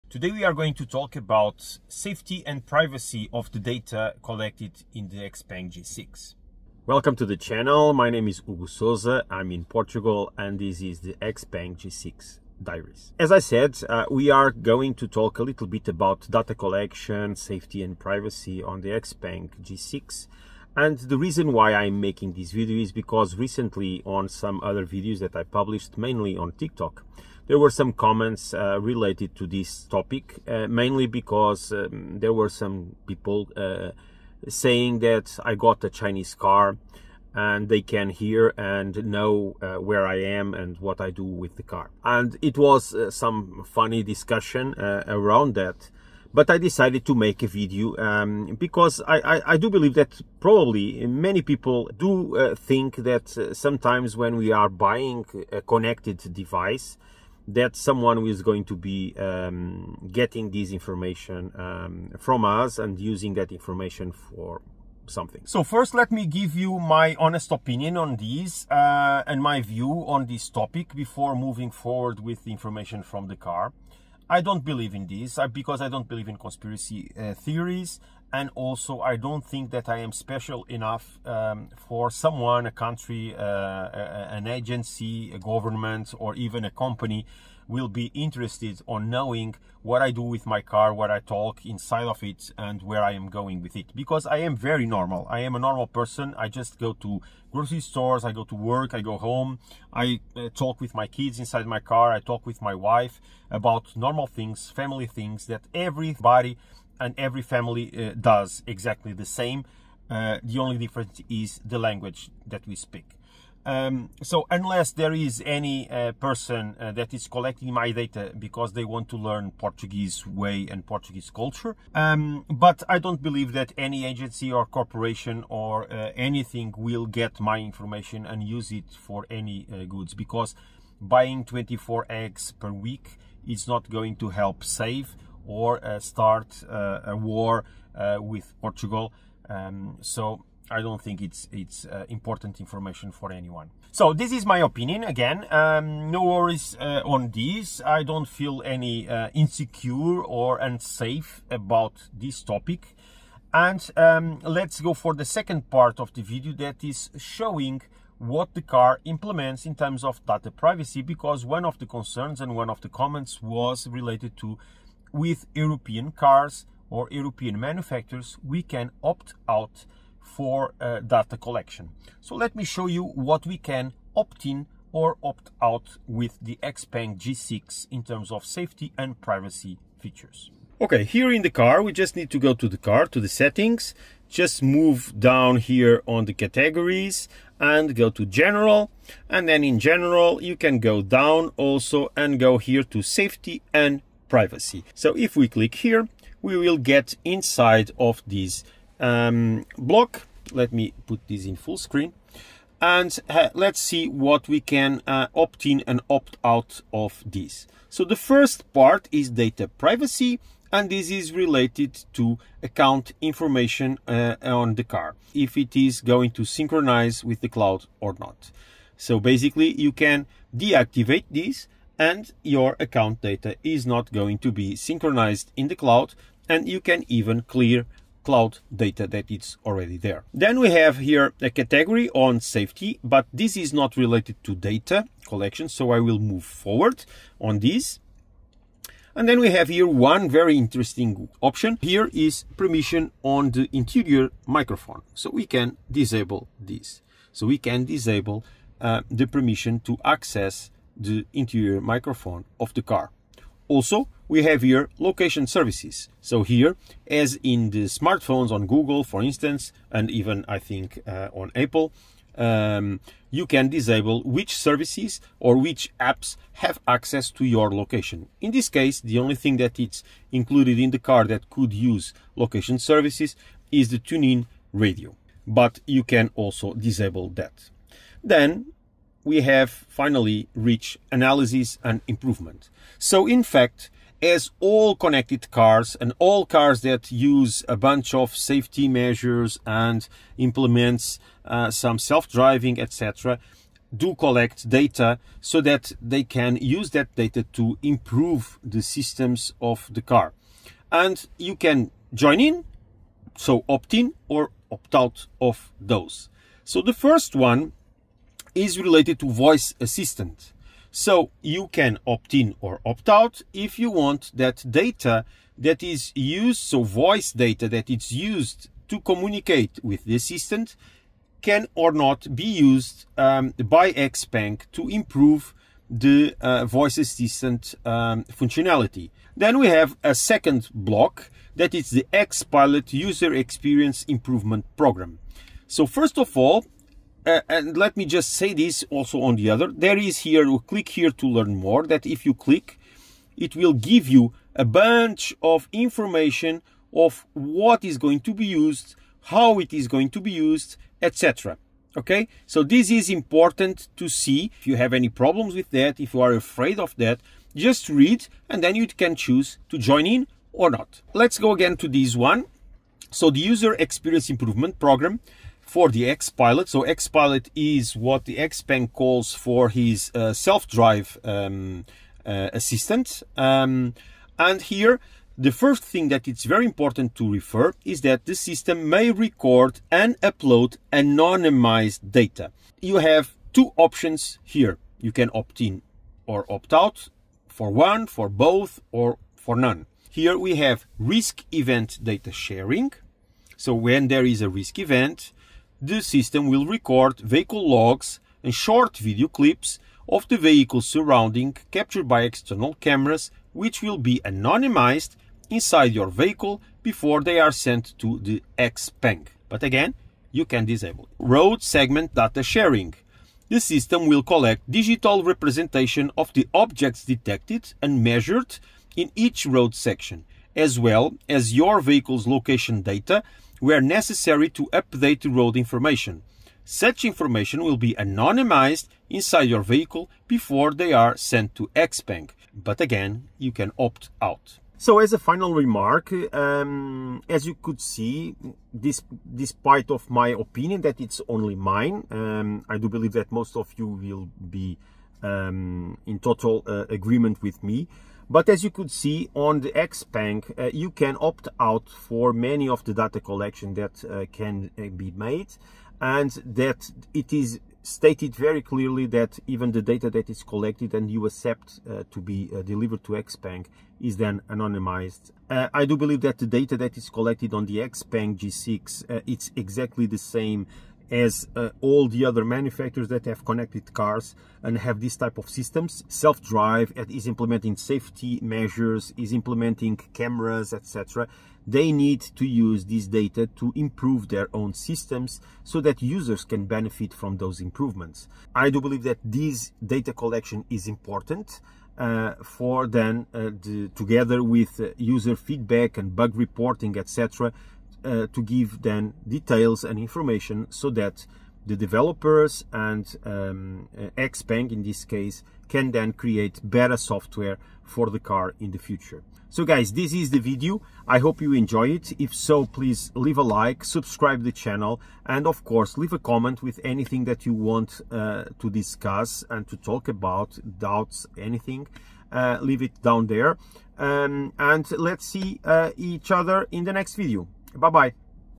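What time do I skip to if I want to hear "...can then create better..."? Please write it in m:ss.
8:25.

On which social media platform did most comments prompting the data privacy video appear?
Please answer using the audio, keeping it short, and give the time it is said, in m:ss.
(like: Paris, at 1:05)
TikTok, at 0:26.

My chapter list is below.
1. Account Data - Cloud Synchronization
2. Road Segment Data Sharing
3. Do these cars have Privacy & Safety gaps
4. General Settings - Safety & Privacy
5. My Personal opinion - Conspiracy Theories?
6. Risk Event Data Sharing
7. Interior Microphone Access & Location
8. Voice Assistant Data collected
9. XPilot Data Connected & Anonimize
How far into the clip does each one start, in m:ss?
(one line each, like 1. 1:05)
1. 3:28
2. 6:51
3. 0:20
4. 3:00
5. 1:05
6. 6:30
7. 3:59
8. 5:06
9. 5:29.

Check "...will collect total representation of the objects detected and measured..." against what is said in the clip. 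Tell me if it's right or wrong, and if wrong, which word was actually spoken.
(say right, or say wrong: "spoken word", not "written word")
wrong: "digital", not "total".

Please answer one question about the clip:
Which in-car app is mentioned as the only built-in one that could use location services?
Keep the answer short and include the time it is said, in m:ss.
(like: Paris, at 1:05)
TuneIn radio, at 4:33.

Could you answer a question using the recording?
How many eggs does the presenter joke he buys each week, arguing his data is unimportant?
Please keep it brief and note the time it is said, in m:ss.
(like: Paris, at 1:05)
24, at 2:11.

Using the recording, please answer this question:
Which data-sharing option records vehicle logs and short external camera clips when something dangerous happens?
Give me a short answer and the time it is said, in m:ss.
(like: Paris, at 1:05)
Risk event data sharing, at 6:30.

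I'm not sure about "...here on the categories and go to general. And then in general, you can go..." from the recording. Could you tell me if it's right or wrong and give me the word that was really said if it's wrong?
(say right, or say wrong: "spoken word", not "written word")
right.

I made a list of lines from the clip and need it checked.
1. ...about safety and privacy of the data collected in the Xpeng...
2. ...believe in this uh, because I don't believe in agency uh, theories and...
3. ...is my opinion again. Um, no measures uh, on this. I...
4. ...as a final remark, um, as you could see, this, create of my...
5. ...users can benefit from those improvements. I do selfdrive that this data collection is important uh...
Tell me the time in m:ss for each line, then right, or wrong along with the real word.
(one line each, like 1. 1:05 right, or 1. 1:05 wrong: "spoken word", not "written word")
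1. 0:01 right
2. 1:14 wrong: "conspiracy", not "agency"
3. 2:24 wrong: "worries", not "measures"
4. 7:14 wrong: "despite", not "create"
5. 8:06 wrong: "believe", not "selfdrive".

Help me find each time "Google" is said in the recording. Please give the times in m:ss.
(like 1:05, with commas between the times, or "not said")
4:18.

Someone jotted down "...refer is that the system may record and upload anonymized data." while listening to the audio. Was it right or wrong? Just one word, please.
right.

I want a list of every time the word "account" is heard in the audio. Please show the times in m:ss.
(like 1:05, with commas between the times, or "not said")
3:32, 3:42.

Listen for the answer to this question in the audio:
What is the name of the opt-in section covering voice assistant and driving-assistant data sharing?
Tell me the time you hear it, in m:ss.
4:41.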